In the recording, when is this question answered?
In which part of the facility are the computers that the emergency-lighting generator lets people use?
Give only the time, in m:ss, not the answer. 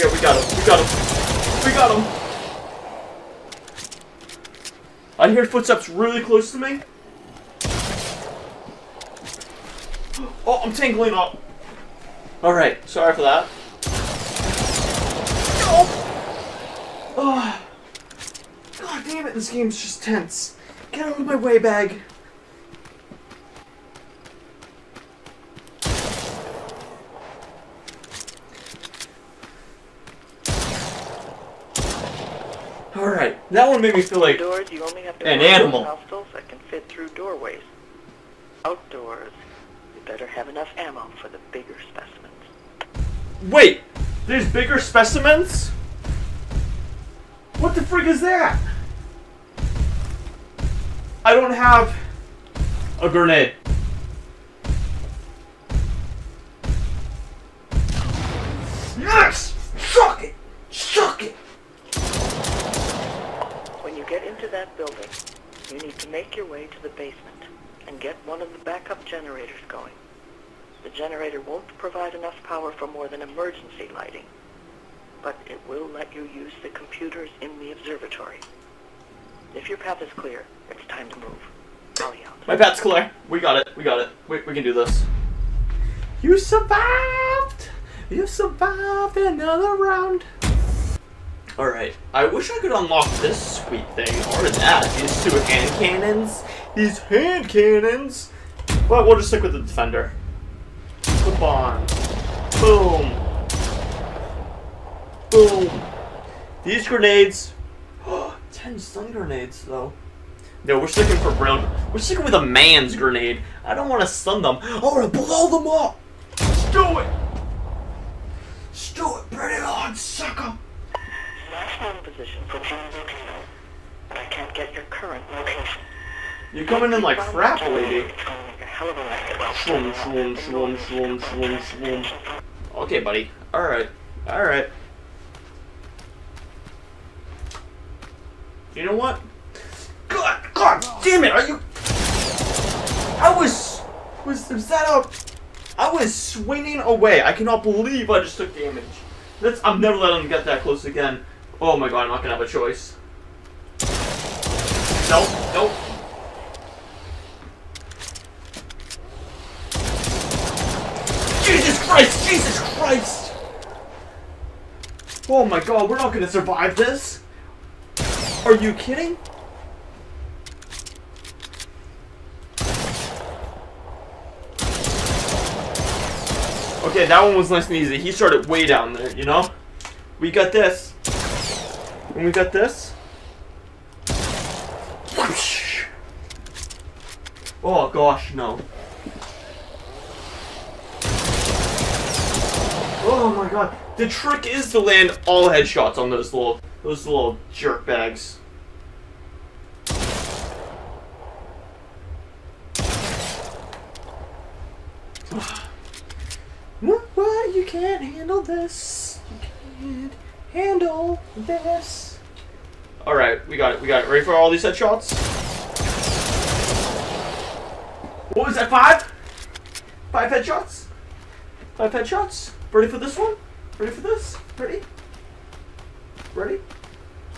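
1:17.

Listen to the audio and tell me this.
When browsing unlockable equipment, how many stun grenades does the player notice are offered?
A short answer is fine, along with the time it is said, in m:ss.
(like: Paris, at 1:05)
10, at 1:48.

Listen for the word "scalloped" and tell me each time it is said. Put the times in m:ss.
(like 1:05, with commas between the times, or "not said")
not said.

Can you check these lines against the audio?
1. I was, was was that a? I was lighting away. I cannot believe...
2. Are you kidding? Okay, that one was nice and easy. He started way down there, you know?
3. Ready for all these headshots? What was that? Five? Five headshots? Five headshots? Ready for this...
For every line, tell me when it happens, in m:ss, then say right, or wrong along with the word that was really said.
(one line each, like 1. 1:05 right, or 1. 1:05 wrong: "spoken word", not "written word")
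1. 2:23 wrong: "swinging", not "lighting"
2. 2:48 right
3. 3:34 right.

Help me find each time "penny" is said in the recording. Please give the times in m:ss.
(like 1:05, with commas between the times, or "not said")
not said.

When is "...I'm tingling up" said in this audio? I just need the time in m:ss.
0:10.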